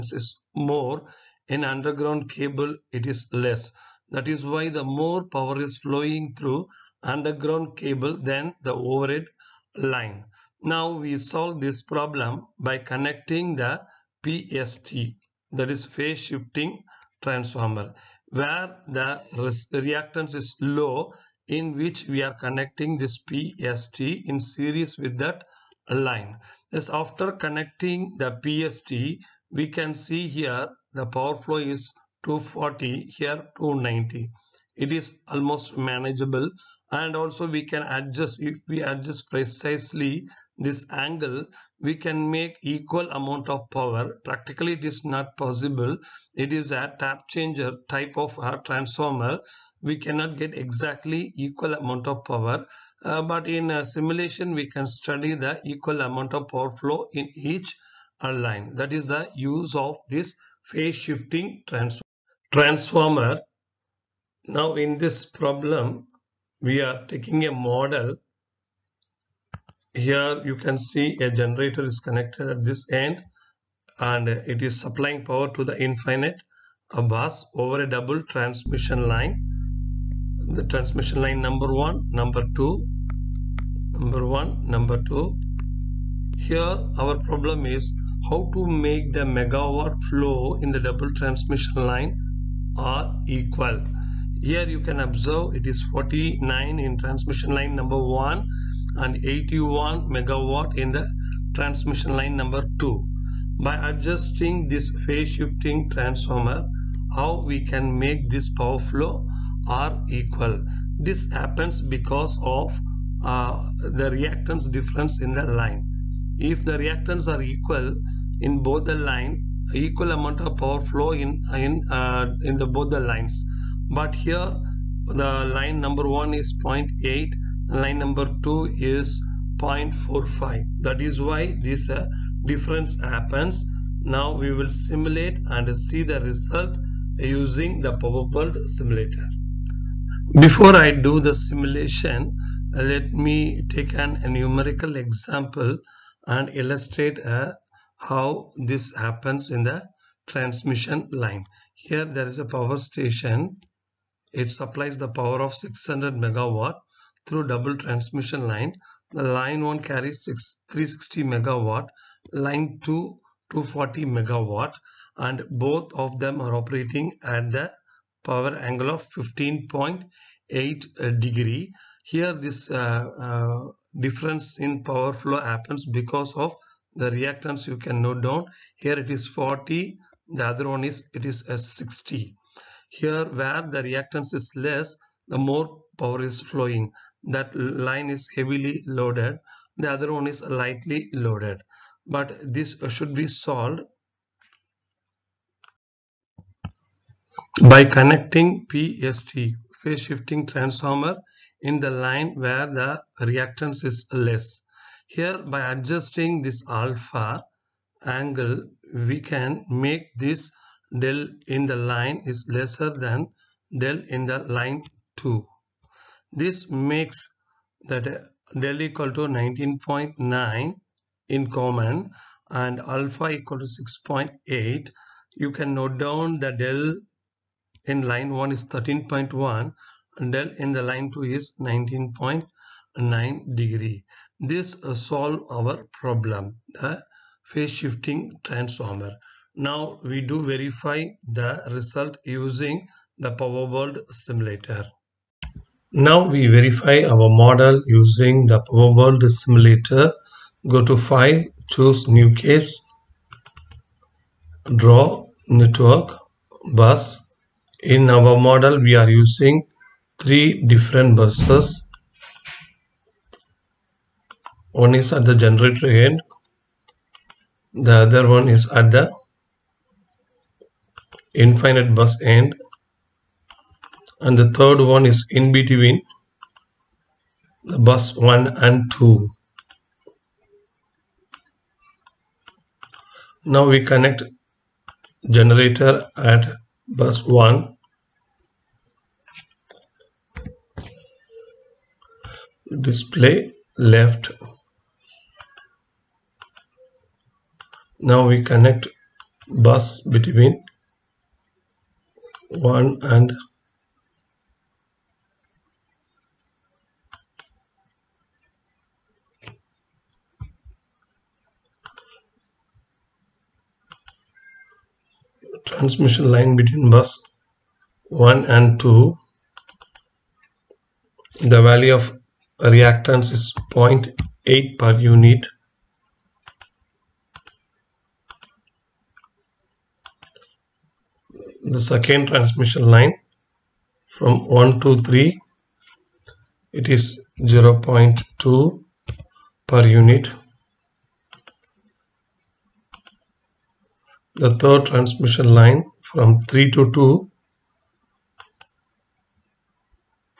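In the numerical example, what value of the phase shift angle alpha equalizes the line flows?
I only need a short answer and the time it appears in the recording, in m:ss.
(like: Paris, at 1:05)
6.8, at 3:43.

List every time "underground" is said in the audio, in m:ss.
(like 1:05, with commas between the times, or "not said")
0:01, 0:07.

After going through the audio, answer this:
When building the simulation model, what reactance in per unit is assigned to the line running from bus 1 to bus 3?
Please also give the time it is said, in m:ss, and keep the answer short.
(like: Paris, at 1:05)
0.2 per unit, at 5:37.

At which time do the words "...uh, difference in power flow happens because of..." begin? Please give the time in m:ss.
2:53.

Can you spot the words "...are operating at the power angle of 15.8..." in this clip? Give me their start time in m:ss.
2:46.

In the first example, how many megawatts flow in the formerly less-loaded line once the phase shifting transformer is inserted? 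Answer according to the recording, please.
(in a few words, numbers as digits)
290.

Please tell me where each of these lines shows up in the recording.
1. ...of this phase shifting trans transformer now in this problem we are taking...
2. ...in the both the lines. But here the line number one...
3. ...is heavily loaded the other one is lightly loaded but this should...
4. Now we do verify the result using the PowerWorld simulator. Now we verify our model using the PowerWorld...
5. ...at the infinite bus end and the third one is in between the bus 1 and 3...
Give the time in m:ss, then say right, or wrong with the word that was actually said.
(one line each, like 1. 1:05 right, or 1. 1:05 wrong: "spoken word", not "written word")
1. 0:59 right
2. 2:02 right
3. 3:08 right
4. 3:59 right
5. 4:28 wrong: "2", not "3".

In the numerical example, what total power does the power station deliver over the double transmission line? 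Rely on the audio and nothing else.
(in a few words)
600 megawatt.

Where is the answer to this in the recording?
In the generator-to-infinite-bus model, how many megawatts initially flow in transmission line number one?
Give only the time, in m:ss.
1:35.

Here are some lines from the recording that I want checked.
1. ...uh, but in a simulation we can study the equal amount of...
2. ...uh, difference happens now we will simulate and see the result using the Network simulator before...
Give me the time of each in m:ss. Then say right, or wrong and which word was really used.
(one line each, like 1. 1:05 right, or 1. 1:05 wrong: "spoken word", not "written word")
1. 0:53 right
2. 2:11 wrong: "PowerWorld", not "Network".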